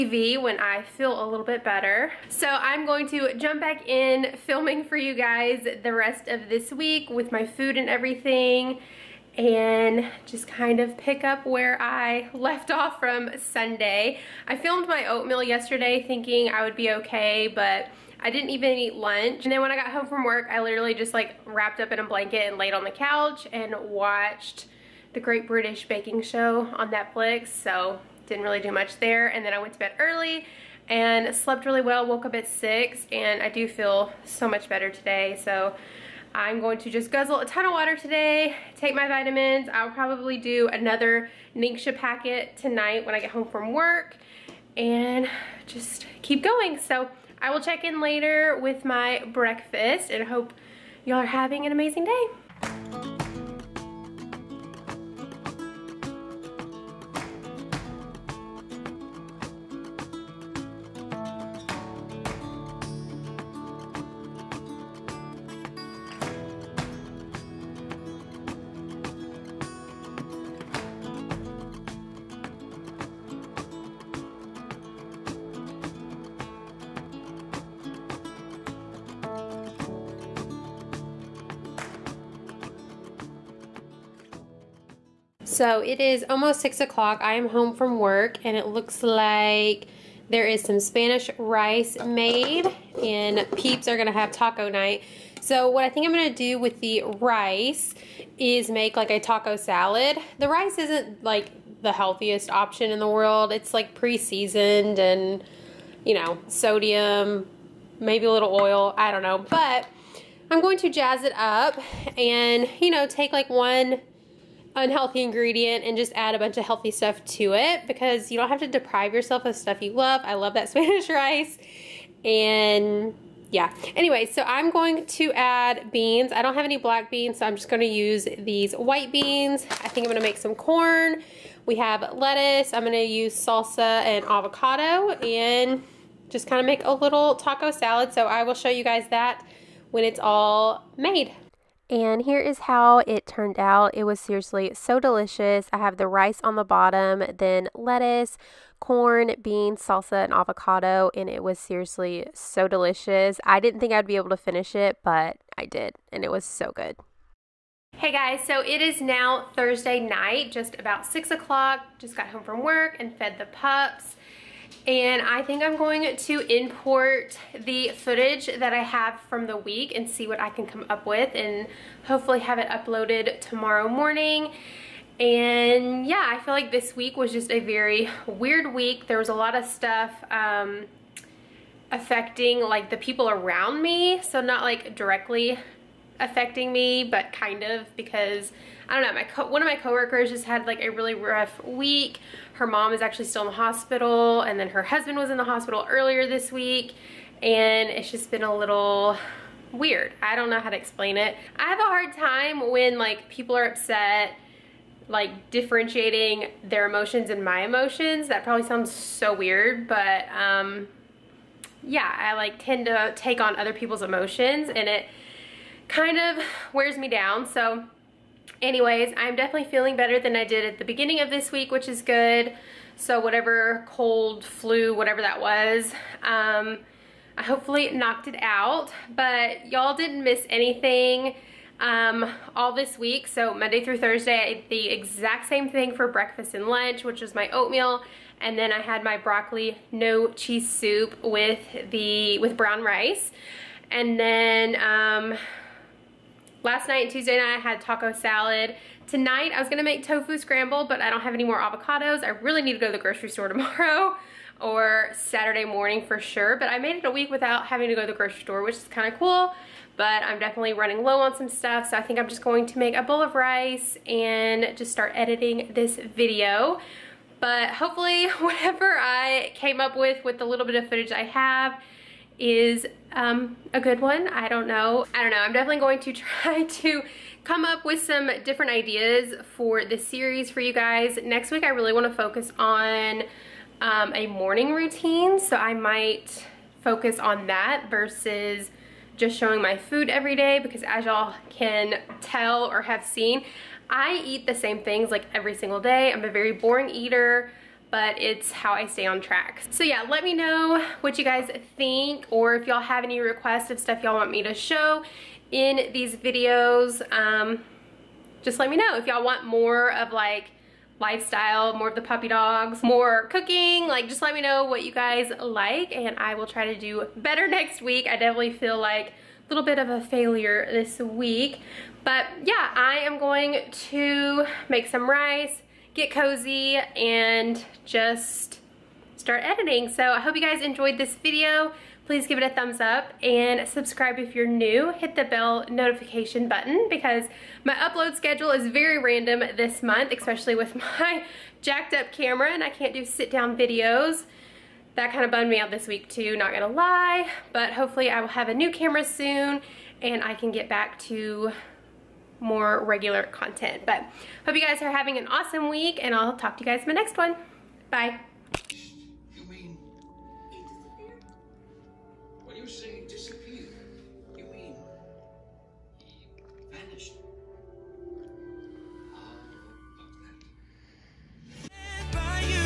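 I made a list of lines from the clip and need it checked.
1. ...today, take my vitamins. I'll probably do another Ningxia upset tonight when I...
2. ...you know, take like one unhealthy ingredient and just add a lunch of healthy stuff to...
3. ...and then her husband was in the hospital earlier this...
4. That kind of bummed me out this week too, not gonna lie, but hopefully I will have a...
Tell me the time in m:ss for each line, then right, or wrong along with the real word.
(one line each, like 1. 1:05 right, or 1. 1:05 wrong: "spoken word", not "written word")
1. 0:37 wrong: "packet", not "upset"
2. 1:52 wrong: "bunch", not "lunch"
3. 3:14 right
4. 5:44 right.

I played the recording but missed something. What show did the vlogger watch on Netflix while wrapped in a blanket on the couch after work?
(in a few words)
Great British Baking Show.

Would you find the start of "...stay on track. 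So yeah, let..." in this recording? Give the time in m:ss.
4:58.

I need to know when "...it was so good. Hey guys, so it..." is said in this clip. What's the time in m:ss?
2:36.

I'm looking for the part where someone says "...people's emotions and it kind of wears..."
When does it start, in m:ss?
3:33.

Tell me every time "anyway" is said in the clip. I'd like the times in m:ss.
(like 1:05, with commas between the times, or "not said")
2:03, 3:38.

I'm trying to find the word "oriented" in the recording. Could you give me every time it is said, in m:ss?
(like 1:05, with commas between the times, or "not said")
not said.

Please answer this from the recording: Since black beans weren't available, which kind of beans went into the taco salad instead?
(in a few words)
white beans.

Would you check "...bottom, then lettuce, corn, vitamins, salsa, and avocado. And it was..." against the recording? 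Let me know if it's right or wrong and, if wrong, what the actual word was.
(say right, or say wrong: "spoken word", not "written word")
wrong: "beans", not "vitamins".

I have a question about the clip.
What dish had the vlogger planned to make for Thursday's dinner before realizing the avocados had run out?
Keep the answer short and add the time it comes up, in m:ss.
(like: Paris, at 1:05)
tofu scramble, at 4:10.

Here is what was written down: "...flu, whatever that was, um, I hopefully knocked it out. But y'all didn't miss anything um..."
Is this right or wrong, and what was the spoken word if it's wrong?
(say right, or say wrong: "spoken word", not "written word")
right.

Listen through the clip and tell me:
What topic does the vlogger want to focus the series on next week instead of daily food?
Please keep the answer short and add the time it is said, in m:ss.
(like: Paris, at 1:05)
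a morning routine, at 4:44.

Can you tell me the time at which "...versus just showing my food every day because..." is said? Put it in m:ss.
4:47.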